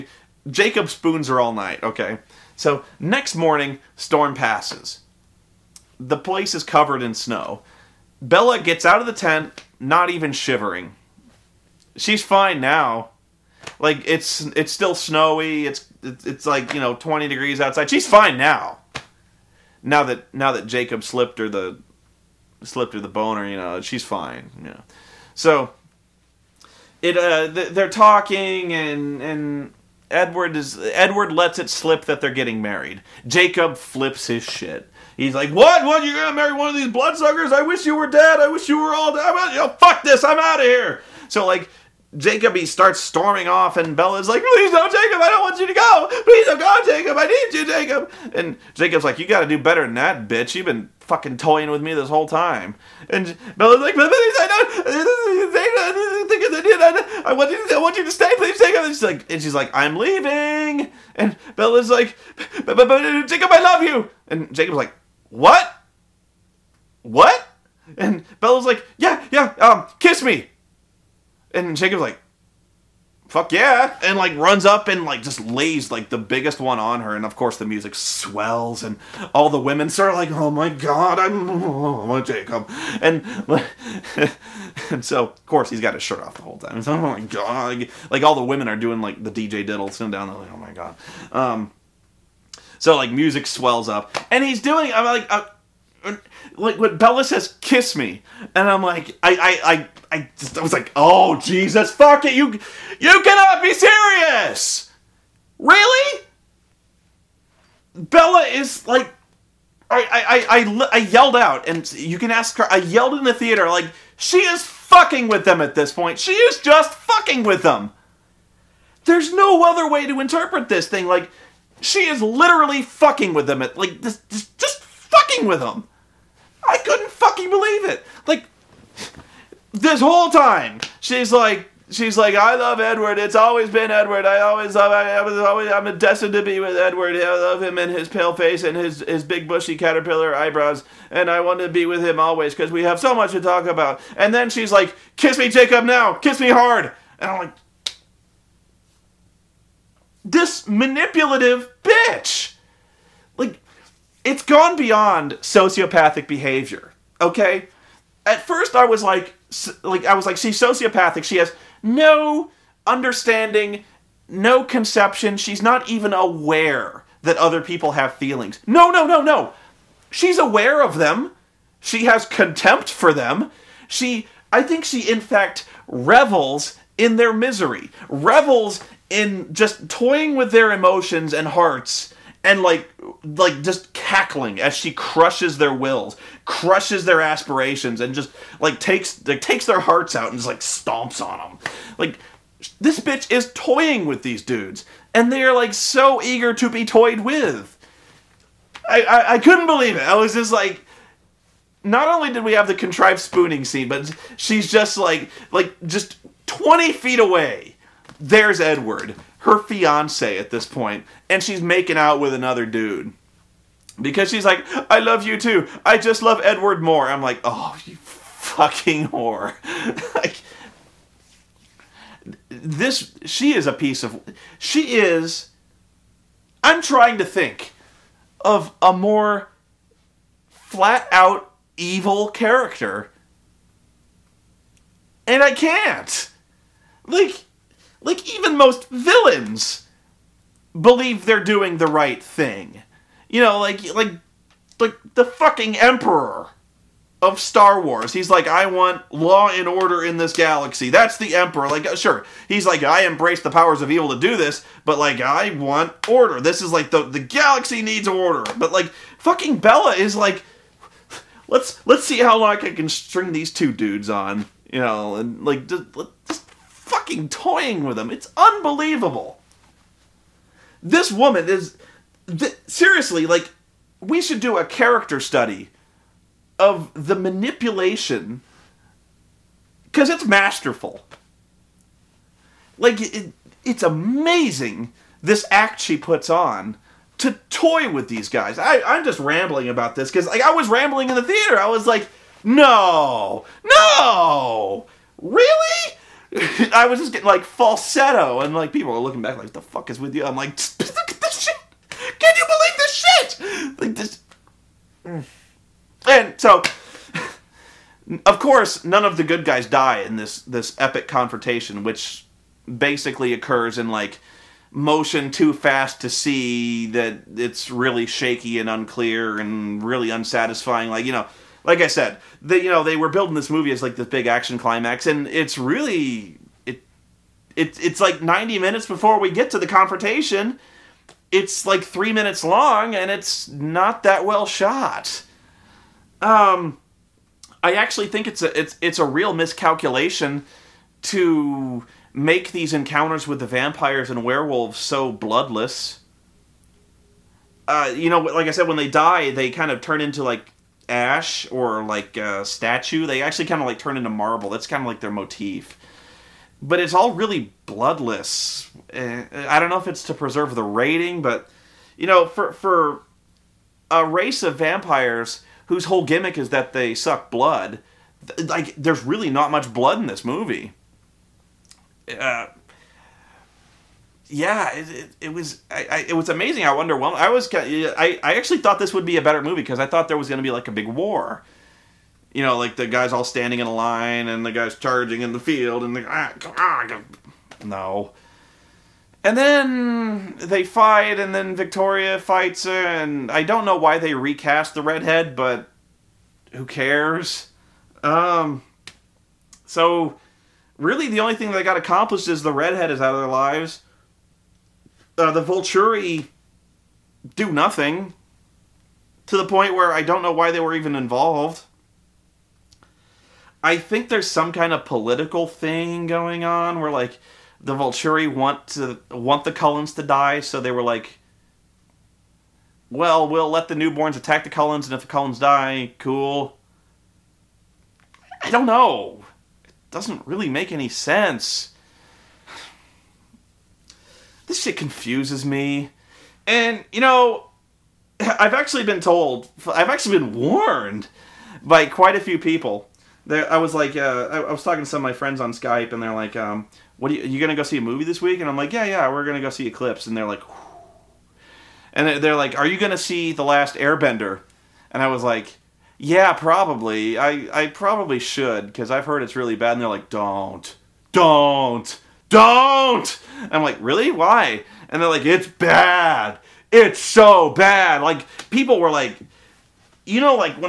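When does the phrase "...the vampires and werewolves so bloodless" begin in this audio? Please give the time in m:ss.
5:43.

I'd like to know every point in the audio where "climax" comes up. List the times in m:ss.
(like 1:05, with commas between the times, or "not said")
5:24.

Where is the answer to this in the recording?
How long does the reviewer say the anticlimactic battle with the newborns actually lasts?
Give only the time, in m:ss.
5:31.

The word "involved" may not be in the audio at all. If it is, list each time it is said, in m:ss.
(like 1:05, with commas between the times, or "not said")
6:50.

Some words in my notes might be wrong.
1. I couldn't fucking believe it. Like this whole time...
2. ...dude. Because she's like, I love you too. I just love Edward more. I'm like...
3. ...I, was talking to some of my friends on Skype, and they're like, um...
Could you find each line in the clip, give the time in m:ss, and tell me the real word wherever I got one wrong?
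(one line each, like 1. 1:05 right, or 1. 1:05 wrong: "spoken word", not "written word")
1. 2:06 right
2. 3:32 right
3. 7:24 right.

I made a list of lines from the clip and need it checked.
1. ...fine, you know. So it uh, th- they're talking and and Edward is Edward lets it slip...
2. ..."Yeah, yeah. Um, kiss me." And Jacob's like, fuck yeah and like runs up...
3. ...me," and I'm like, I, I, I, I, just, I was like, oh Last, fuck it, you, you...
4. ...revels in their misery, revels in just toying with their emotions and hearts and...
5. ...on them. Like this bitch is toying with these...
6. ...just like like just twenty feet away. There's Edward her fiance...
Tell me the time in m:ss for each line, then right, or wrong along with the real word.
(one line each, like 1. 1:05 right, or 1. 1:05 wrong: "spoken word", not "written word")
1. 0:24 right
2. 1:08 right
3. 1:37 wrong: "Jesus", not "Last"
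4. 2:55 right
5. 3:11 right
6. 3:24 right.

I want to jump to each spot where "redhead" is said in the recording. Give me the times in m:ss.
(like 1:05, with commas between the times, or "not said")
6:34, 6:42.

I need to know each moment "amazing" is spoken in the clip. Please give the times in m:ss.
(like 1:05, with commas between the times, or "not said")
4:43, 6:16.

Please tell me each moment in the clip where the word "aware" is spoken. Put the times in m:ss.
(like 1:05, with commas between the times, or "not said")
2:46, 2:50.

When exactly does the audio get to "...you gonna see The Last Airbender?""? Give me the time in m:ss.
7:32.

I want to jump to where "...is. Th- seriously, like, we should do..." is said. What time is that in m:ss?
4:31.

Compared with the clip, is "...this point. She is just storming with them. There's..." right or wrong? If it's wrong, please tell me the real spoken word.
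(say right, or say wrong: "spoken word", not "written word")
wrong: "fucking", not "storming".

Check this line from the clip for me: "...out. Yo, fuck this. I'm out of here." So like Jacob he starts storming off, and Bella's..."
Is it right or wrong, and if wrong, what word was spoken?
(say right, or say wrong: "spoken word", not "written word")
right.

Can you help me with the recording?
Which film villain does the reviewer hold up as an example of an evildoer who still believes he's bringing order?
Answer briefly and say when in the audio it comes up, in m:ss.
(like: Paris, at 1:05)
The Emperor, at 4:05.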